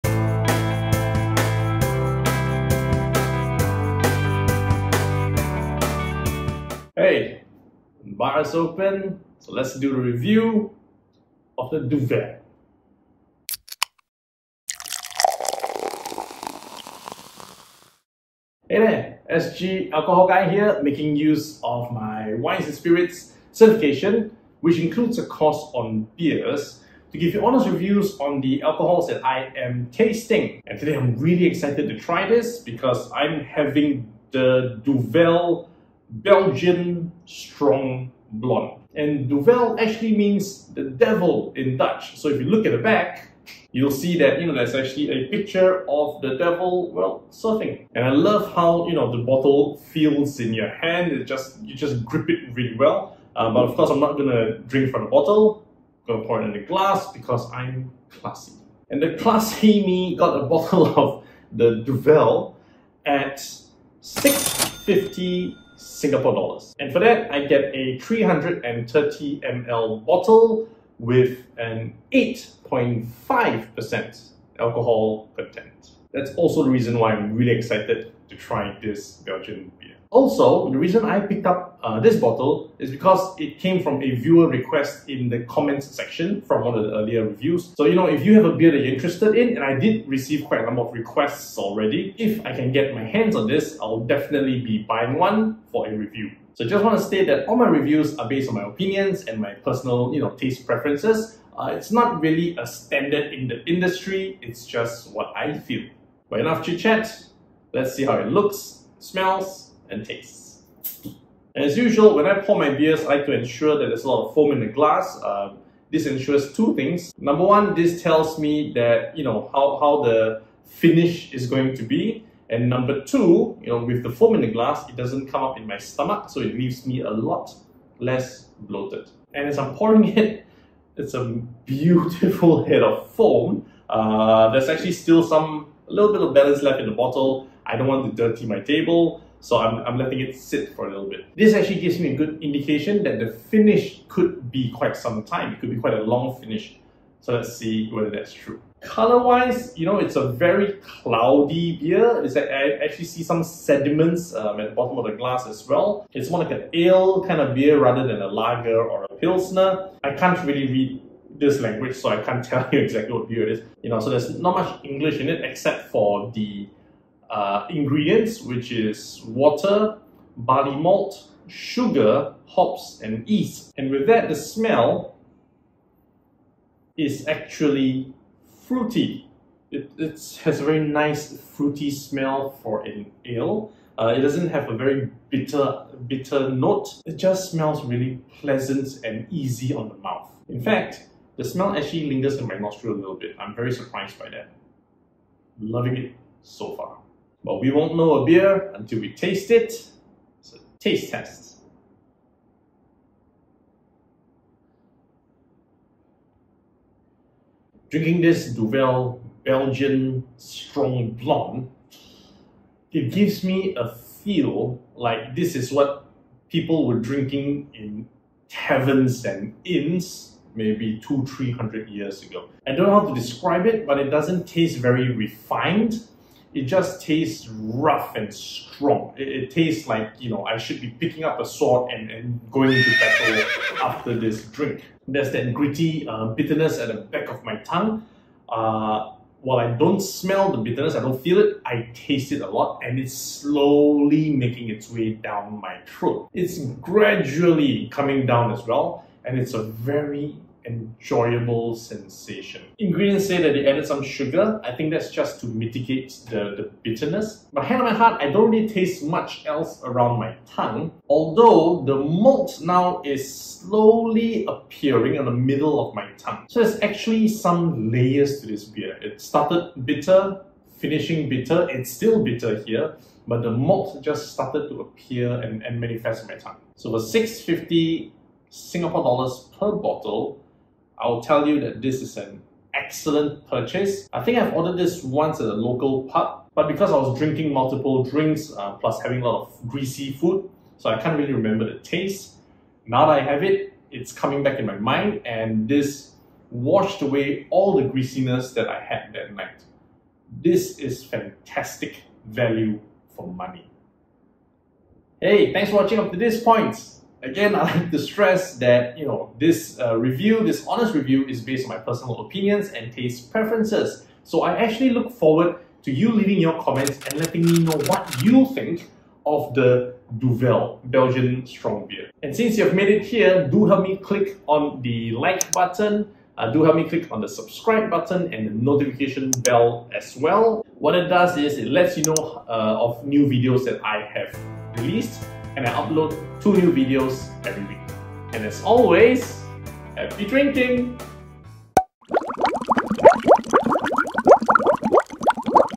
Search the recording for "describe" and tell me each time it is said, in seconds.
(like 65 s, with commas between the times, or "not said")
223 s.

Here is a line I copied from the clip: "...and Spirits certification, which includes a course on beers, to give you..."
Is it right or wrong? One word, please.
right.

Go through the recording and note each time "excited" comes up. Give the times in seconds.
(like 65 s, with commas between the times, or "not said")
31 s, 77 s.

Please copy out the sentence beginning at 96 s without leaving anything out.
So just want to state that all my reviews are based on my opinions and my personal, you know, taste preferences.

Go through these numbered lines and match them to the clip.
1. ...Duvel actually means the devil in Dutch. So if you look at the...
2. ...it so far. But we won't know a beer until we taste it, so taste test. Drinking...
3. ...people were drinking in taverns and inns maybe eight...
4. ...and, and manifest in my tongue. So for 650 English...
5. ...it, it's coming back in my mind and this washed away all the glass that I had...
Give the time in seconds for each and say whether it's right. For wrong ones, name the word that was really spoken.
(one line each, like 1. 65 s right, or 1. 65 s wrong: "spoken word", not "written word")
1. 39 s right
2. 195 s right
3. 216 s wrong: "two", not "eight"
4. 275 s wrong: "Singapore", not "English"
5. 293 s wrong: "greasiness", not "glass".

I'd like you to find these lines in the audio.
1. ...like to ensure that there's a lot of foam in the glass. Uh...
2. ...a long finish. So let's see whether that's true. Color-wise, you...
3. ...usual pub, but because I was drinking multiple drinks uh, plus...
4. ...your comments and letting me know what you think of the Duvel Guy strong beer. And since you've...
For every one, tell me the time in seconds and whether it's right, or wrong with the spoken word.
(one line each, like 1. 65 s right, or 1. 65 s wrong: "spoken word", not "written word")
1. 113 s right
2. 145 s right
3. 285 s wrong: "local", not "usual"
4. 316 s wrong: "Belgian", not "Guy".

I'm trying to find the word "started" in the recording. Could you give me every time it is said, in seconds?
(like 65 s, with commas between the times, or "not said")
269 s, 274 s.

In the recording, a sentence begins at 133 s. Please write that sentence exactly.
Uh, there's actually still some, a little bit of balance left in the bottle.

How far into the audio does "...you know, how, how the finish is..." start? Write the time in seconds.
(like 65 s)
119 s.